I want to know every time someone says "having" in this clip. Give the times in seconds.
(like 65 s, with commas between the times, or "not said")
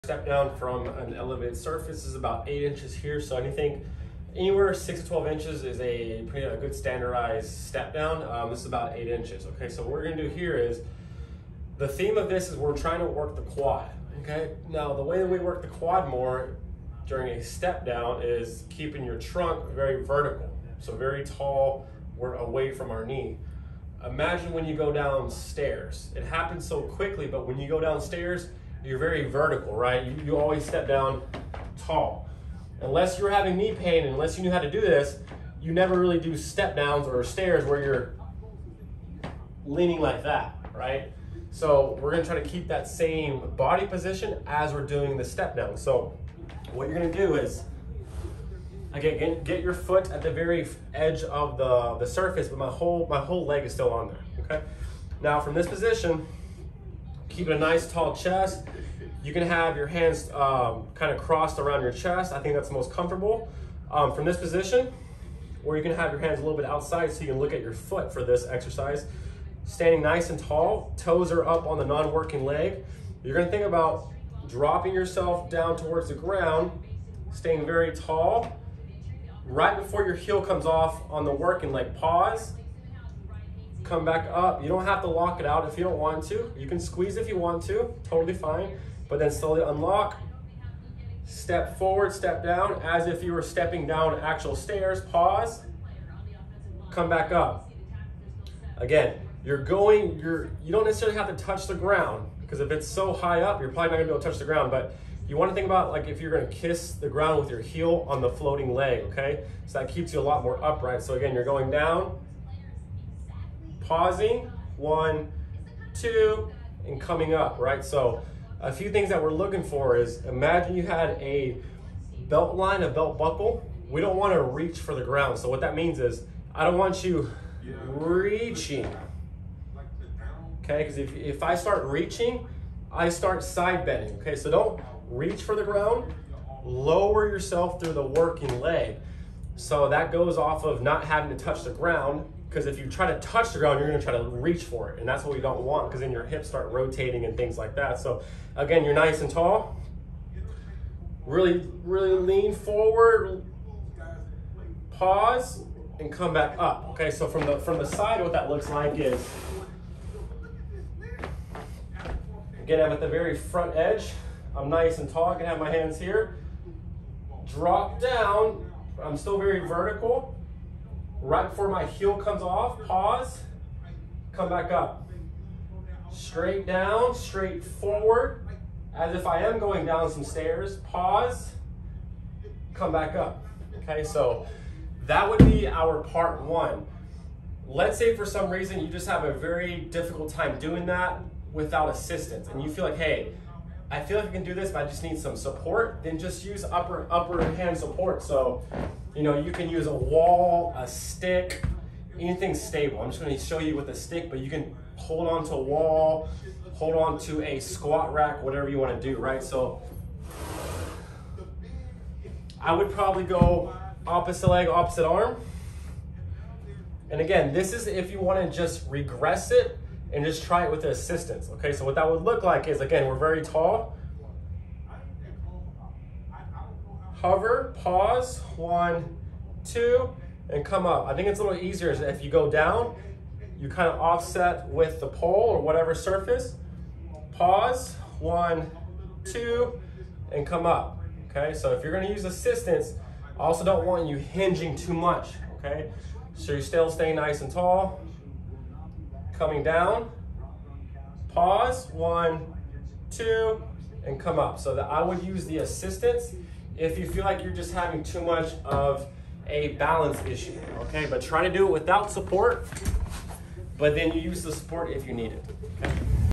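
33 s, 141 s, 257 s.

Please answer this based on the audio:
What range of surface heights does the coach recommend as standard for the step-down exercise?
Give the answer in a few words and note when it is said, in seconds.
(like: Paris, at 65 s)
6 to 12 inches, at 4 s.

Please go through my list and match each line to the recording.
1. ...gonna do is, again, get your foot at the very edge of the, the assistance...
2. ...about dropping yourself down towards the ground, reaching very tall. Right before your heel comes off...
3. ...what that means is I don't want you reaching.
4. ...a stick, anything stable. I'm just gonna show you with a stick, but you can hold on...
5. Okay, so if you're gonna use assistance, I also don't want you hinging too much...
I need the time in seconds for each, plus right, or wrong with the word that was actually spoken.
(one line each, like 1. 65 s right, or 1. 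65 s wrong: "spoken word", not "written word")
1. 46 s wrong: "surface", not "assistance"
2. 73 s wrong: "staying", not "reaching"
3. 125 s right
4. 200 s right
5. 241 s right.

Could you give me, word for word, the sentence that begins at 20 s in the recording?
So very tall, we're away from our knee.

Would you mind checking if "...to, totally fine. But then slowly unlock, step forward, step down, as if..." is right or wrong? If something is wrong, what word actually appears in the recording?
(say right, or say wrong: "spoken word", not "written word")
right.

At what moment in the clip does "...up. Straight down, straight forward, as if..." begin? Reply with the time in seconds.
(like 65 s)
174 s.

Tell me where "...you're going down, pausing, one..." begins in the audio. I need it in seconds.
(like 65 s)
111 s.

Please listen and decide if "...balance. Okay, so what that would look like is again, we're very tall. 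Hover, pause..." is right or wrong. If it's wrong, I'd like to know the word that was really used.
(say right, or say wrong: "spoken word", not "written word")
wrong: "assistance", not "balance".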